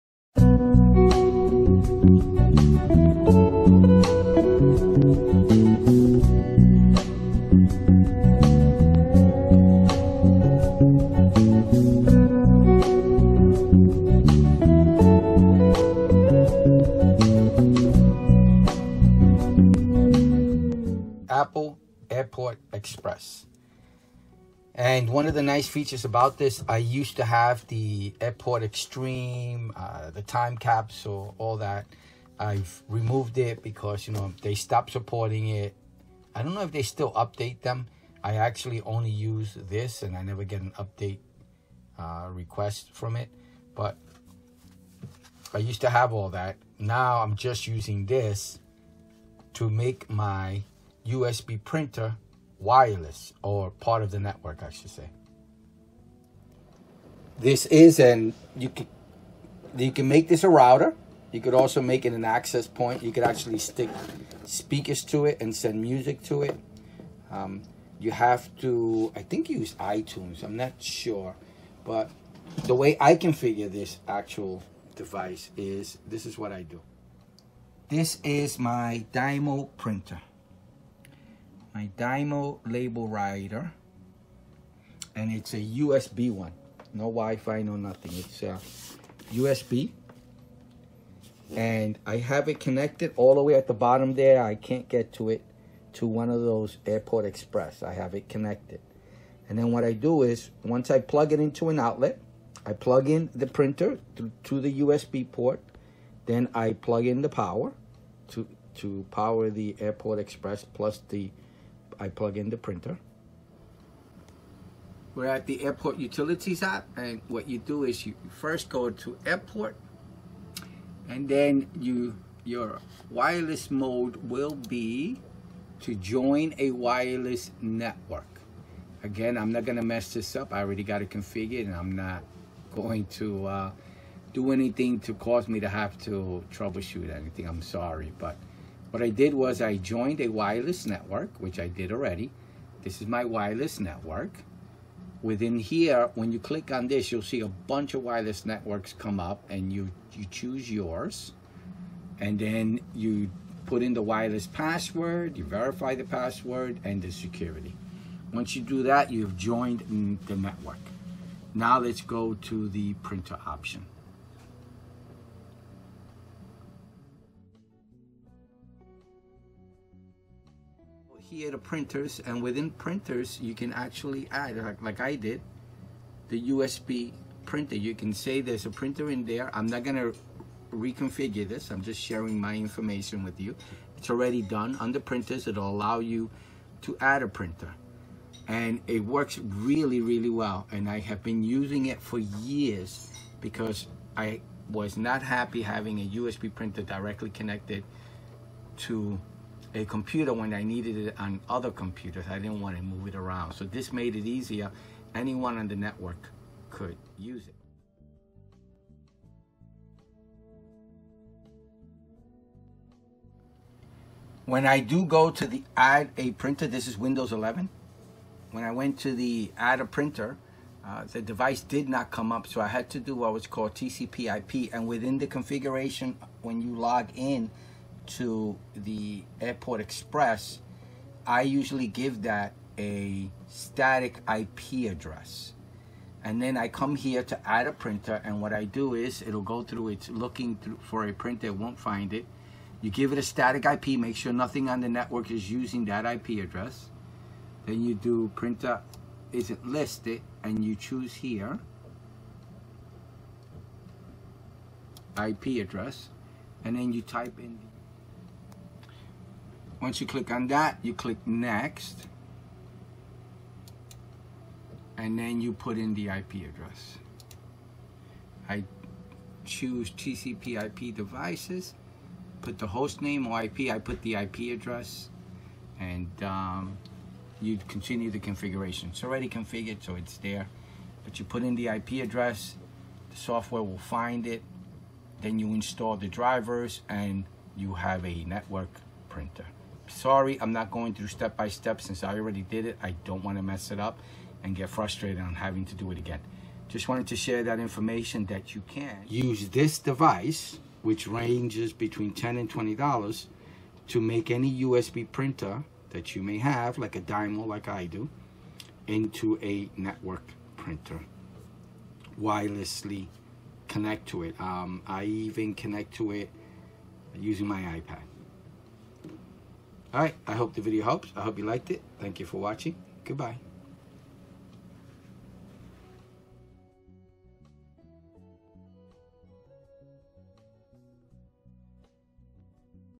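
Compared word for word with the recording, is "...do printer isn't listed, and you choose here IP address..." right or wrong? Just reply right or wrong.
right.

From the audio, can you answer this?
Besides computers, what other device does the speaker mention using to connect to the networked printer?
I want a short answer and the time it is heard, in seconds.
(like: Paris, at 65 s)
iPad, at 317 s.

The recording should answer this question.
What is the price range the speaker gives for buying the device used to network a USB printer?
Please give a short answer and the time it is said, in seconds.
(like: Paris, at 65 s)
$10 to $20, at 301 s.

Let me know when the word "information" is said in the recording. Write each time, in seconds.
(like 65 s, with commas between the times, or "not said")
182 s, 297 s.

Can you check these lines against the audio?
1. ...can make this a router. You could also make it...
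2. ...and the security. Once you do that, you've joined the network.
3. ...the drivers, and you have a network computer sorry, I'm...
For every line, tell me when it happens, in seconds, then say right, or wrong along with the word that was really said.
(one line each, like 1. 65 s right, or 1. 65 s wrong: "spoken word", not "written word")
1. 59 s right
2. 156 s right
3. 285 s wrong: "printer", not "computer".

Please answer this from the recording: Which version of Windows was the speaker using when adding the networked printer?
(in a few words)
Windows 11.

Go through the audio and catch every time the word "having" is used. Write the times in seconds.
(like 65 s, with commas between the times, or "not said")
195 s, 295 s.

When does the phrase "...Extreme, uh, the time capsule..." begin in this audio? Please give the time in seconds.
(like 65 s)
28 s.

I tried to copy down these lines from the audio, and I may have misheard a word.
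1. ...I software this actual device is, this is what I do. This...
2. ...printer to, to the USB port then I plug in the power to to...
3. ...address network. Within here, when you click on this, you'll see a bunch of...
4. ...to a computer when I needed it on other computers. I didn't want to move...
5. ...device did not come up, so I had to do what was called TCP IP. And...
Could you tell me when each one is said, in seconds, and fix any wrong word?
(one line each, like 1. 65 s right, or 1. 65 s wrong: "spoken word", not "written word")
1. 72 s wrong: "configure", not "software"
2. 103 s right
3. 143 s wrong: "wireless", not "address"
4. 198 s right
5. 221 s right.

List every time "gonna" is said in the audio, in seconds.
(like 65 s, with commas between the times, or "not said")
129 s, 179 s.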